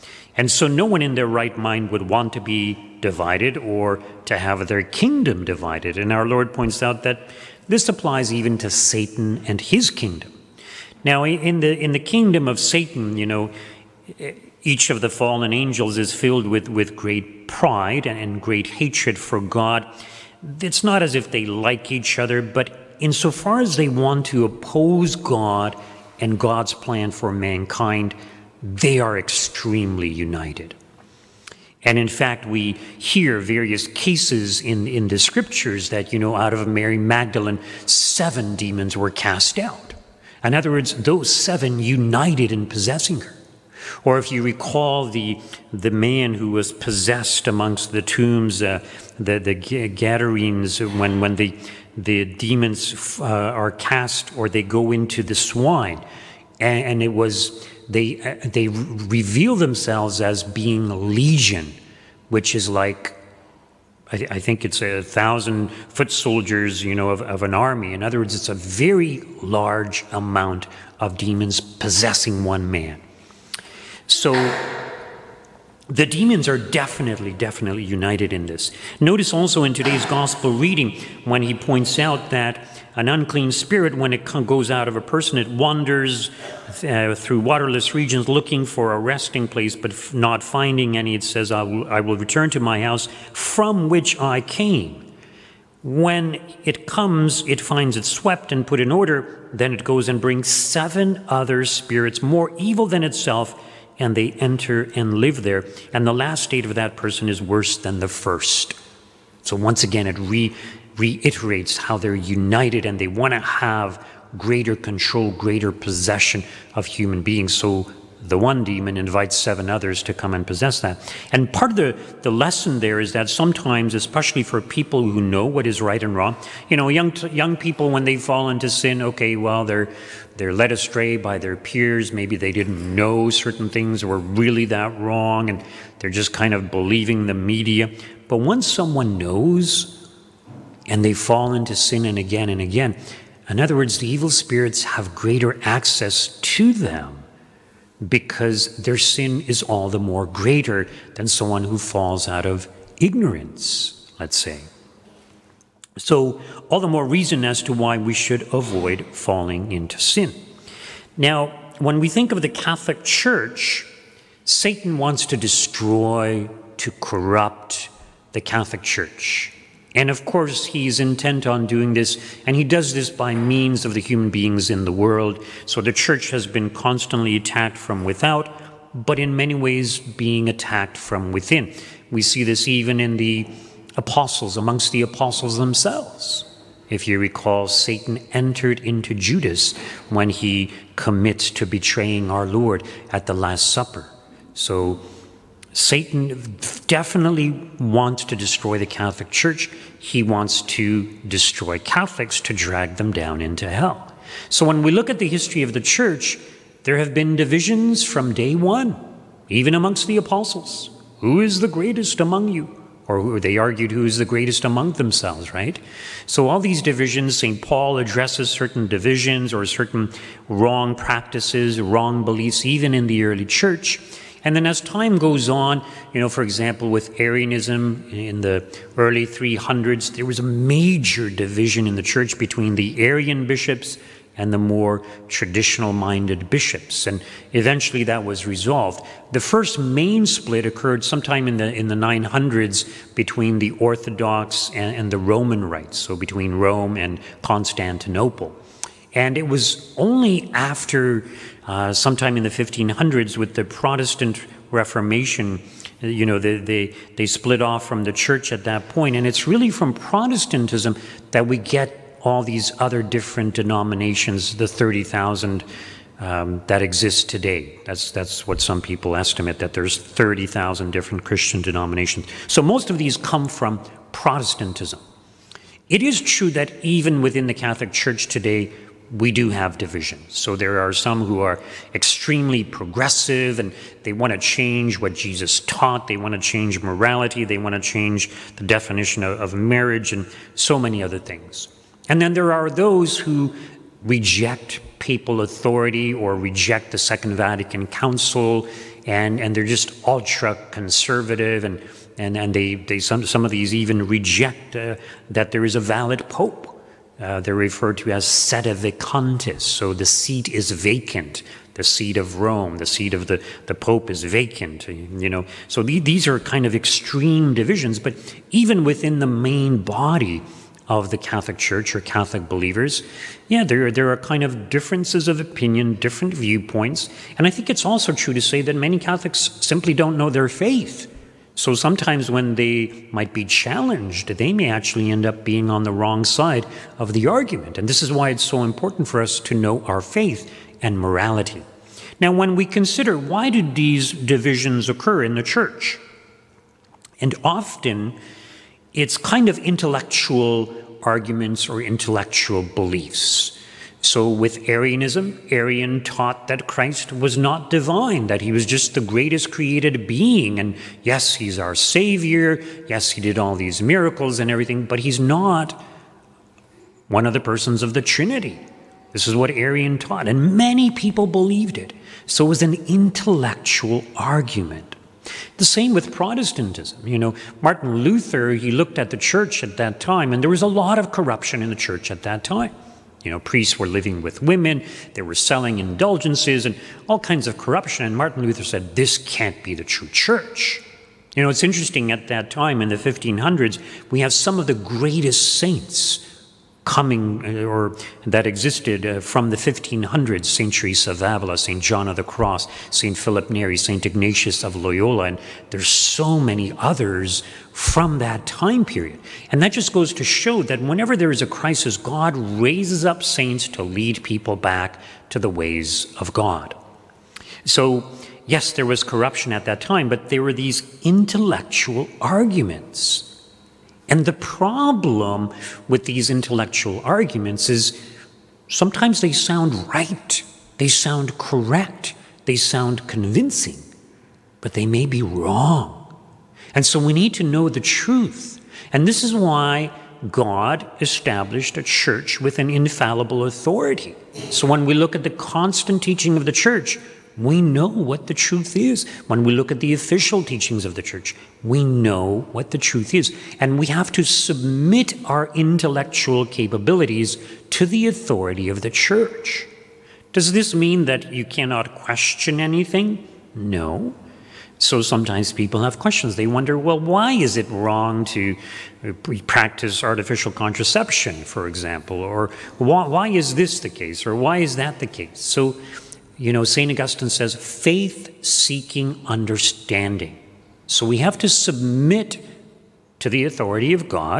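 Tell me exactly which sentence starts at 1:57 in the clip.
So the one demon invites seven others to come and possess that.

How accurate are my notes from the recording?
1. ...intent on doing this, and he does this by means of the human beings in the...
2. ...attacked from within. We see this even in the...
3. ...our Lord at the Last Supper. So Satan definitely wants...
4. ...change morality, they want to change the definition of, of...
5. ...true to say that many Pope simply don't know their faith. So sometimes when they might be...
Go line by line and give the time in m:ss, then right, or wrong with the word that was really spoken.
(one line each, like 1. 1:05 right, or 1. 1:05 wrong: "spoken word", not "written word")
1. 2:50 right
2. 3:00 right
3. 3:12 right
4. 4:46 right
5. 5:28 wrong: "Catholics", not "Pope".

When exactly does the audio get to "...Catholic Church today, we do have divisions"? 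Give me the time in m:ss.
4:37.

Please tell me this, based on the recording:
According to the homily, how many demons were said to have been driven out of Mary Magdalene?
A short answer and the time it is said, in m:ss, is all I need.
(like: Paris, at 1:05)
7, at 0:37.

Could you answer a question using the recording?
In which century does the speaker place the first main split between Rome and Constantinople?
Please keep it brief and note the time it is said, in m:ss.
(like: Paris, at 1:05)
900s, at 4:01.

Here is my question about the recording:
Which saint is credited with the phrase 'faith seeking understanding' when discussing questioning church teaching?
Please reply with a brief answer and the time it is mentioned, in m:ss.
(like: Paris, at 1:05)
St. Augustine, at 7:56.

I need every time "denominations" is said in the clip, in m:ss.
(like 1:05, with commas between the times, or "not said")
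4:23, 4:31.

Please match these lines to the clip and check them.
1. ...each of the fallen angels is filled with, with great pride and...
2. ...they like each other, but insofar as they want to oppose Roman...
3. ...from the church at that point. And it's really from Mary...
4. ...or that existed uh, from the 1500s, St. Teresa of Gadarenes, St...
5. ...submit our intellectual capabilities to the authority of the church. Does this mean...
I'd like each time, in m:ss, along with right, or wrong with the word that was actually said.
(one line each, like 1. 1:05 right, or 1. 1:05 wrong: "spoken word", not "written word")
1. 0:14 right
2. 0:21 wrong: "God", not "Roman"
3. 4:17 wrong: "Protestantism", not "Mary"
4. 6:37 wrong: "Avila", not "Gadarenes"
5. 7:34 right.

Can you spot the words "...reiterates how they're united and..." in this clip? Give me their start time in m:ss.
1:50.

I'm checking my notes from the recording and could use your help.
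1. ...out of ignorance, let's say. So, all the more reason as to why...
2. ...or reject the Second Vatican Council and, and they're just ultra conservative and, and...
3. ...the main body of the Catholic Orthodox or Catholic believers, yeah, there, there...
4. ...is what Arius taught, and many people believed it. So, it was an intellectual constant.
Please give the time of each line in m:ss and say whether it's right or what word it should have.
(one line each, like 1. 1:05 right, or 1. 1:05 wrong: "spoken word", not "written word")
1. 2:32 right
2. 4:56 right
3. 5:19 wrong: "Church", not "Orthodox"
4. 6:09 wrong: "argument", not "constant".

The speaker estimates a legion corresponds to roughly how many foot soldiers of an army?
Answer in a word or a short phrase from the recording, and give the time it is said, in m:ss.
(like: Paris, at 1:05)
1,000, at 1:04.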